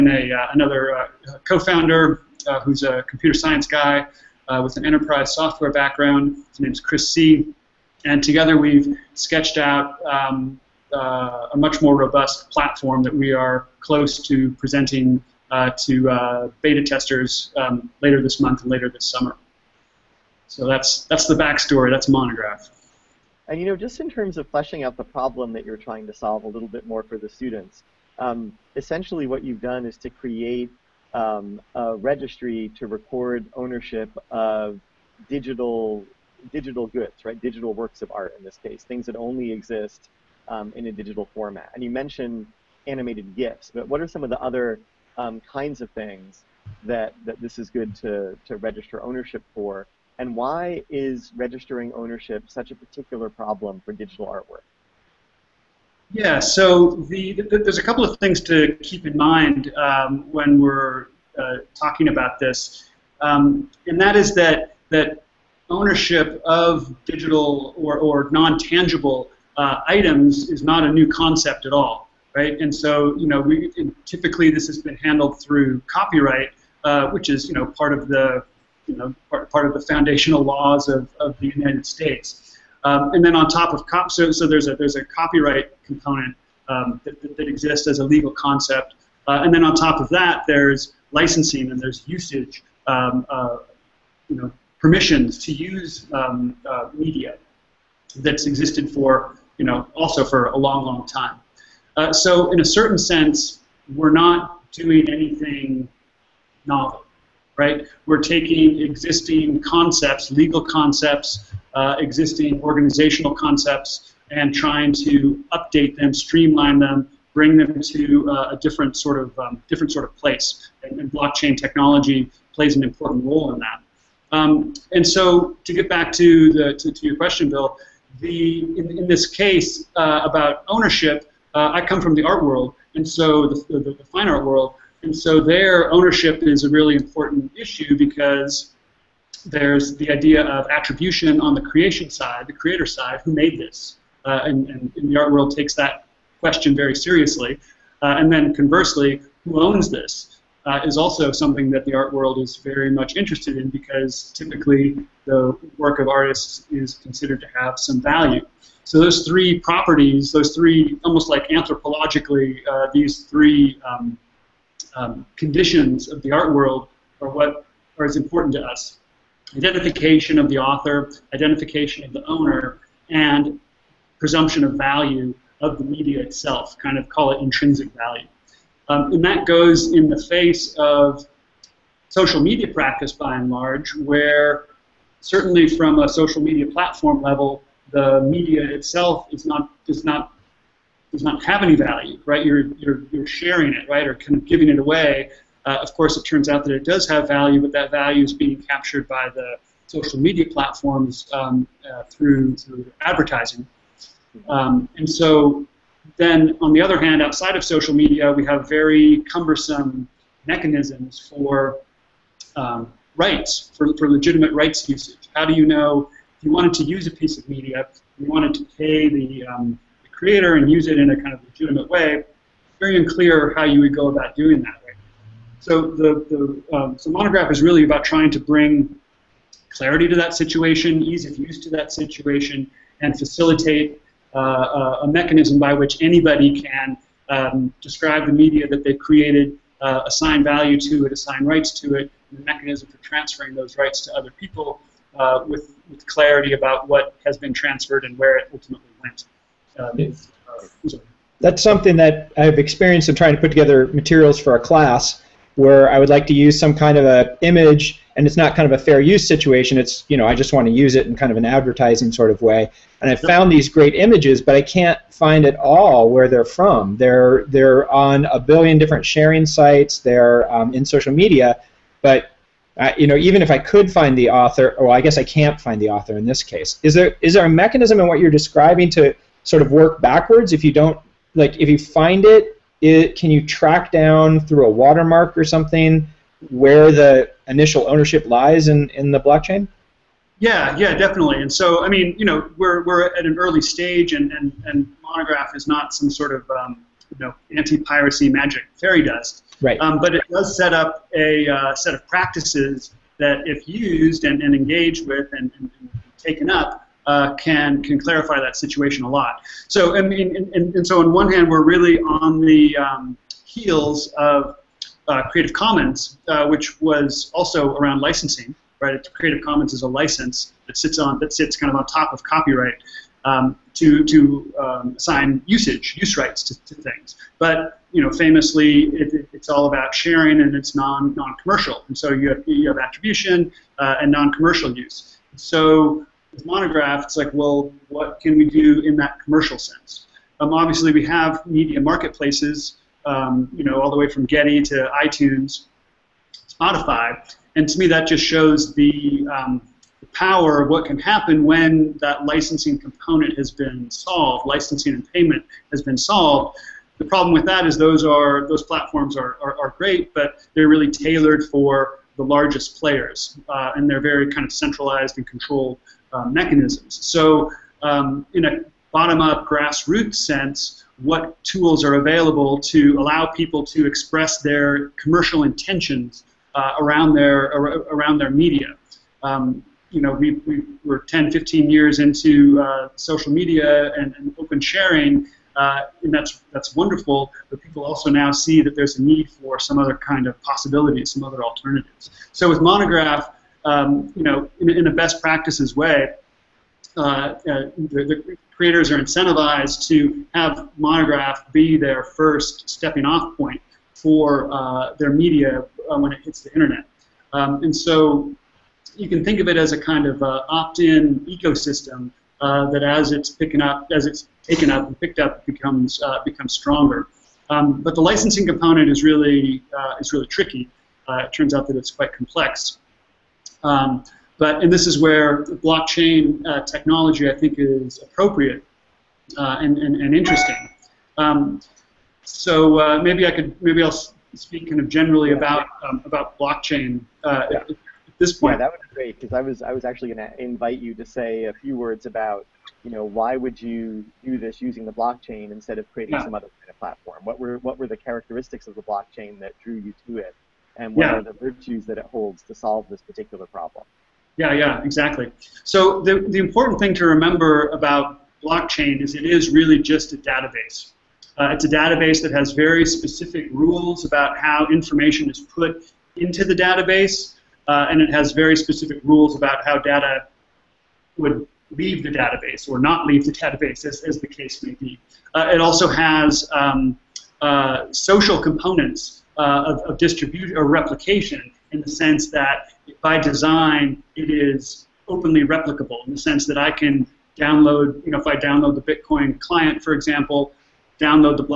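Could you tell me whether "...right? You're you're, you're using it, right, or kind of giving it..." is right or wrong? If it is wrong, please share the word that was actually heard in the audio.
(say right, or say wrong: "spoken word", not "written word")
wrong: "sharing", not "using".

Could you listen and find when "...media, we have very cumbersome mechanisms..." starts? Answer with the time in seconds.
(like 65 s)
207 s.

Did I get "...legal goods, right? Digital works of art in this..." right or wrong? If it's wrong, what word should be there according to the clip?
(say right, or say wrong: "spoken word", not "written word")
wrong: "digital", not "legal".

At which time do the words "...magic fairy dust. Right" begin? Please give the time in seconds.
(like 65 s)
298 s.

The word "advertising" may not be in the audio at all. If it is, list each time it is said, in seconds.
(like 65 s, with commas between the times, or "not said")
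203 s, 261 s.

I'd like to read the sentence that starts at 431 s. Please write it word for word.
Um, so uh, maybe I could maybe I'll speak kind of generally yeah.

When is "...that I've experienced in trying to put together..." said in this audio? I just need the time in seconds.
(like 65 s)
251 s.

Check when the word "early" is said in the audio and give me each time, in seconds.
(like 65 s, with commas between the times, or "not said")
293 s.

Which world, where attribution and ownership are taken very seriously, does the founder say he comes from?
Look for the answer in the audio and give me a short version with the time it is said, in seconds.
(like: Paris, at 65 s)
fine art world, at 134 s.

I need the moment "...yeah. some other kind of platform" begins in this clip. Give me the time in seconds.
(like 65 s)
446 s.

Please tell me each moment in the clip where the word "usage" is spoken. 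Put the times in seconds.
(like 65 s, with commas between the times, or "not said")
92 s, 214 s, 325 s.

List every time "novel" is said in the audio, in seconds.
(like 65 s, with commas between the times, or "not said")
106 s.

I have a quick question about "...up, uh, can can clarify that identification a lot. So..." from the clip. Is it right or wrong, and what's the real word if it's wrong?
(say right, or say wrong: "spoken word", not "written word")
wrong: "situation", not "identification".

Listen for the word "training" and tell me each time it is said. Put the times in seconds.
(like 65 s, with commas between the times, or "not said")
not said.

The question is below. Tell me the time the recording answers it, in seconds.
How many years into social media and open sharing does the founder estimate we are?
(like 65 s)
380 s.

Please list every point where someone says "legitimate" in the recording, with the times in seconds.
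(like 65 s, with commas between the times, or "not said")
214 s, 221 s.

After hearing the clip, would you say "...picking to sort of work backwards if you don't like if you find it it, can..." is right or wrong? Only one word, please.
wrong.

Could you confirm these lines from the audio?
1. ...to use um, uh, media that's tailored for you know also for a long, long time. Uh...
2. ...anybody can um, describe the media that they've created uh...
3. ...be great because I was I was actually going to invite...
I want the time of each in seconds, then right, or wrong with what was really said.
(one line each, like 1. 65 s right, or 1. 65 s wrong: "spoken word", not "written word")
1. 95 s wrong: "existed", not "tailored"
2. 236 s right
3. 438 s right.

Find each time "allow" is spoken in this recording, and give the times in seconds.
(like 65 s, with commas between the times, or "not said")
372 s.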